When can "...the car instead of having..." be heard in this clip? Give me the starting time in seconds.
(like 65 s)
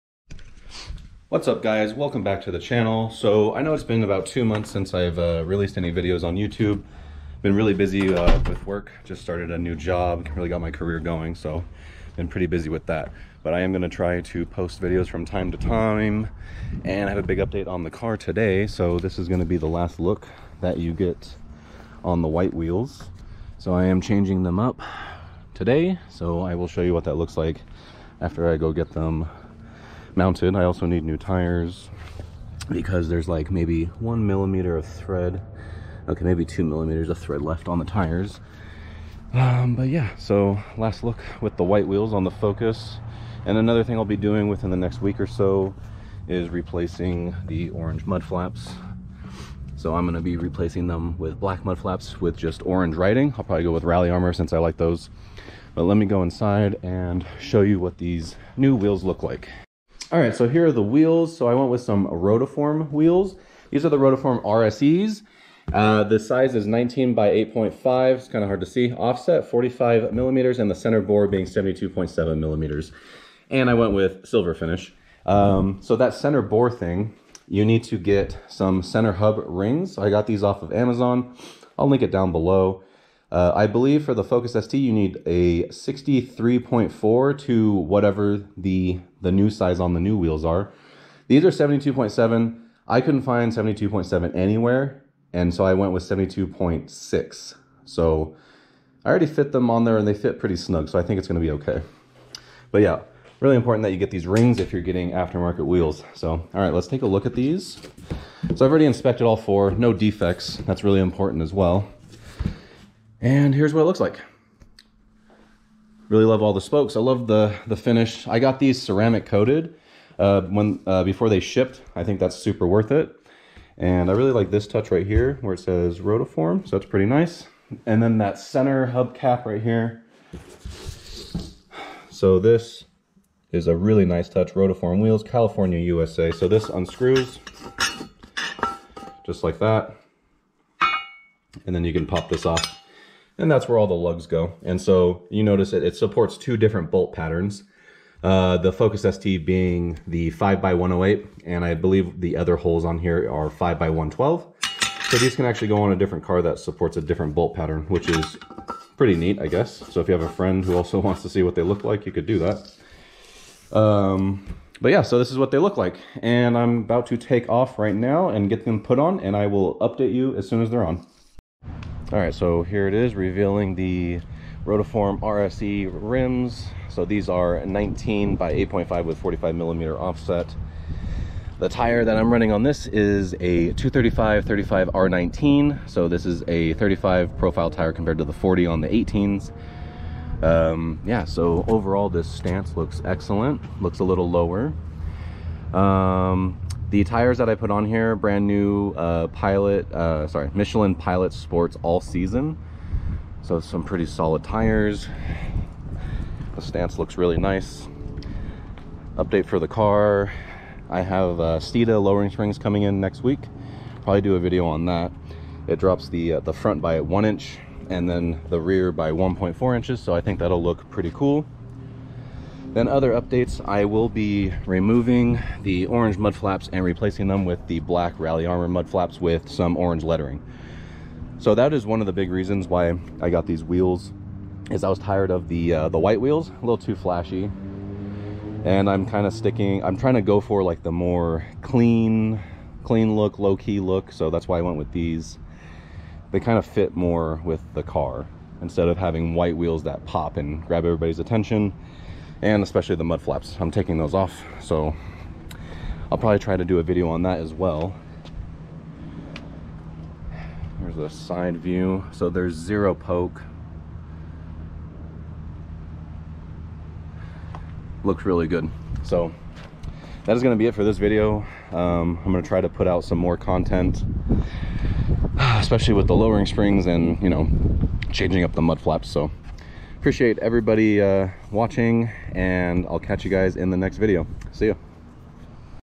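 247 s.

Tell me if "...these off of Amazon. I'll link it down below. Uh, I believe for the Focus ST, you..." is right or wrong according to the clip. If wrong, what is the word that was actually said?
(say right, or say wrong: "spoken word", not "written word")
right.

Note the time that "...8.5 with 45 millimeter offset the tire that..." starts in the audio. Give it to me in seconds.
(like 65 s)
178 s.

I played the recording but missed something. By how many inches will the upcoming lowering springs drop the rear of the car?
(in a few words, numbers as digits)
1.4 inches.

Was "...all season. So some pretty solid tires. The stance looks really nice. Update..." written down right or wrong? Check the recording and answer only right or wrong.
right.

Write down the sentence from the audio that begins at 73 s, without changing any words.
And I went with silver finish.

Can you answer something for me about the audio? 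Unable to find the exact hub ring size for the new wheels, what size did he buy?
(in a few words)
72.6.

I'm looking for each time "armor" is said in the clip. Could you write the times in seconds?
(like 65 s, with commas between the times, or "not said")
54 s, 228 s.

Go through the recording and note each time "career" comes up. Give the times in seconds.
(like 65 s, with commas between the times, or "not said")
10 s.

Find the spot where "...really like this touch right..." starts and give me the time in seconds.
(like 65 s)
124 s.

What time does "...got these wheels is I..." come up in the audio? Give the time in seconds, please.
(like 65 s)
233 s.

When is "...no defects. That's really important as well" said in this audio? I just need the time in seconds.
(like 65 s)
109 s.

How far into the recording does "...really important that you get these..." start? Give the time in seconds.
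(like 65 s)
103 s.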